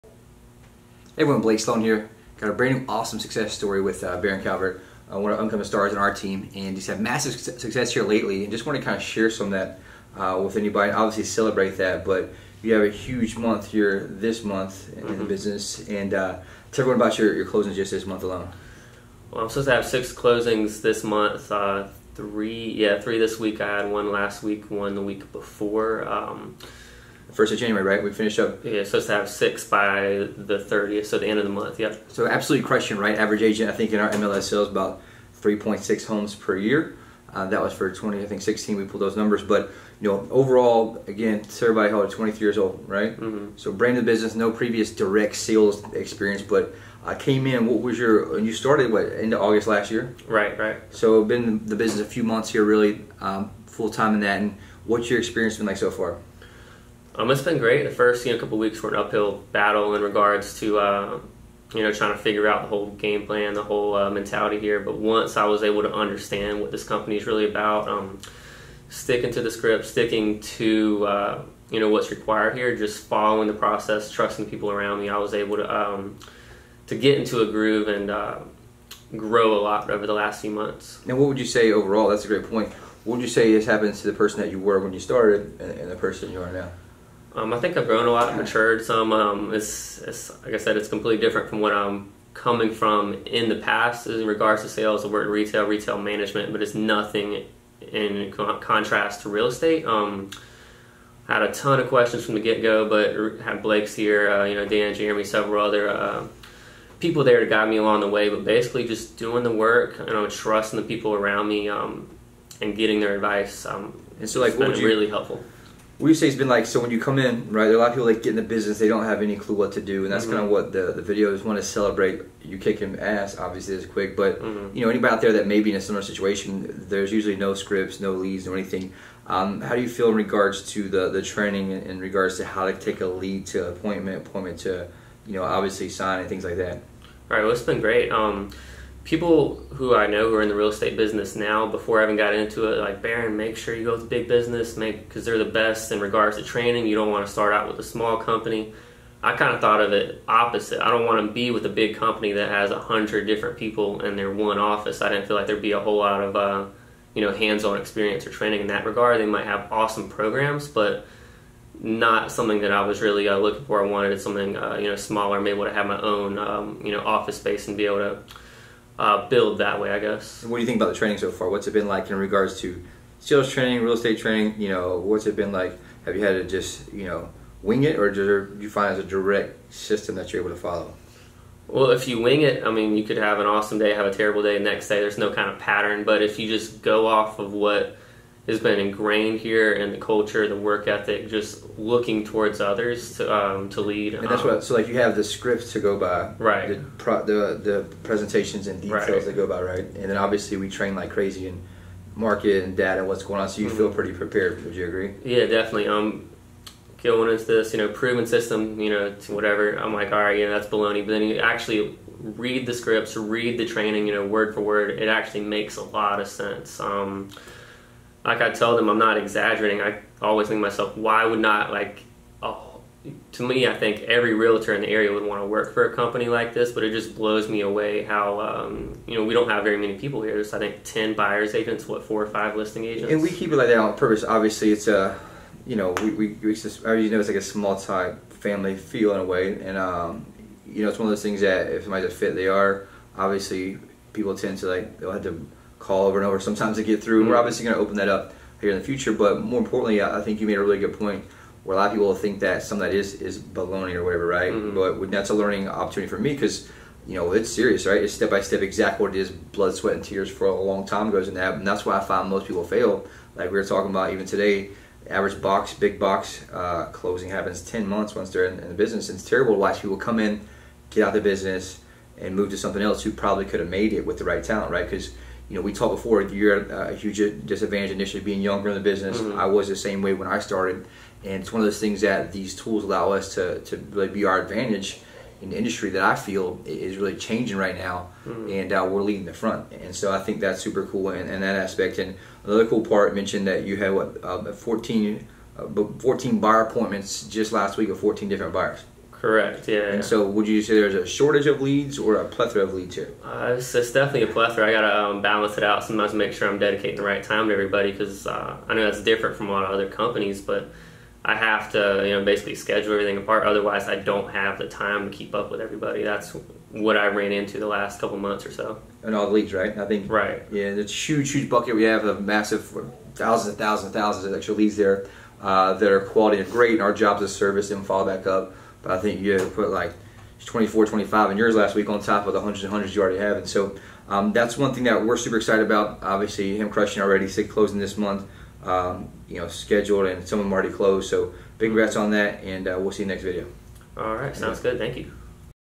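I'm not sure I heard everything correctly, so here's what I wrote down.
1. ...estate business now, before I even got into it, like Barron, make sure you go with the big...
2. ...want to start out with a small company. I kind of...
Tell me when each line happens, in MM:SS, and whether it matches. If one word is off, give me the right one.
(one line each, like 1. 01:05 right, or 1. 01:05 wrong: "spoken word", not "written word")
1. 02:20 right
2. 02:27 right.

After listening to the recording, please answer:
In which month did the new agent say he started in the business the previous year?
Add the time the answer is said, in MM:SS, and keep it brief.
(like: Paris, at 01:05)
August, at 00:49.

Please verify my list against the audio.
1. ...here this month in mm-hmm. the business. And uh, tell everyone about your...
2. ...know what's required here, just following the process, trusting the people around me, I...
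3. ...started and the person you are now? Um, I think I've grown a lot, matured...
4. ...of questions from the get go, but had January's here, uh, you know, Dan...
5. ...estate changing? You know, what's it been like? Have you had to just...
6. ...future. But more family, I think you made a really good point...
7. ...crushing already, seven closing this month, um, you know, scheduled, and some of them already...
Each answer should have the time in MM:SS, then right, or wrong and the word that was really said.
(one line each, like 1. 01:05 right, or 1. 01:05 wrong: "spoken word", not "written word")
1. 00:13 right
2. 01:11 right
3. 01:25 right
4. 01:41 wrong: "Blake", not "January"
5. 02:53 wrong: "training", not "changing"
6. 04:08 wrong: "importantly", not "family"
7. 05:36 wrong: "six", not "seven".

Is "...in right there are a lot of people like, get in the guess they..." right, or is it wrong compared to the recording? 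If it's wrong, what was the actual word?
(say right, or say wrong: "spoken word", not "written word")
wrong: "business", not "guess".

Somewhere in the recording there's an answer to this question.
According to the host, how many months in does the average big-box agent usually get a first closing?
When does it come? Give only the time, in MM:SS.
04:27.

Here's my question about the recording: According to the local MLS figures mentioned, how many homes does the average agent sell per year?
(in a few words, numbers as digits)
3.6.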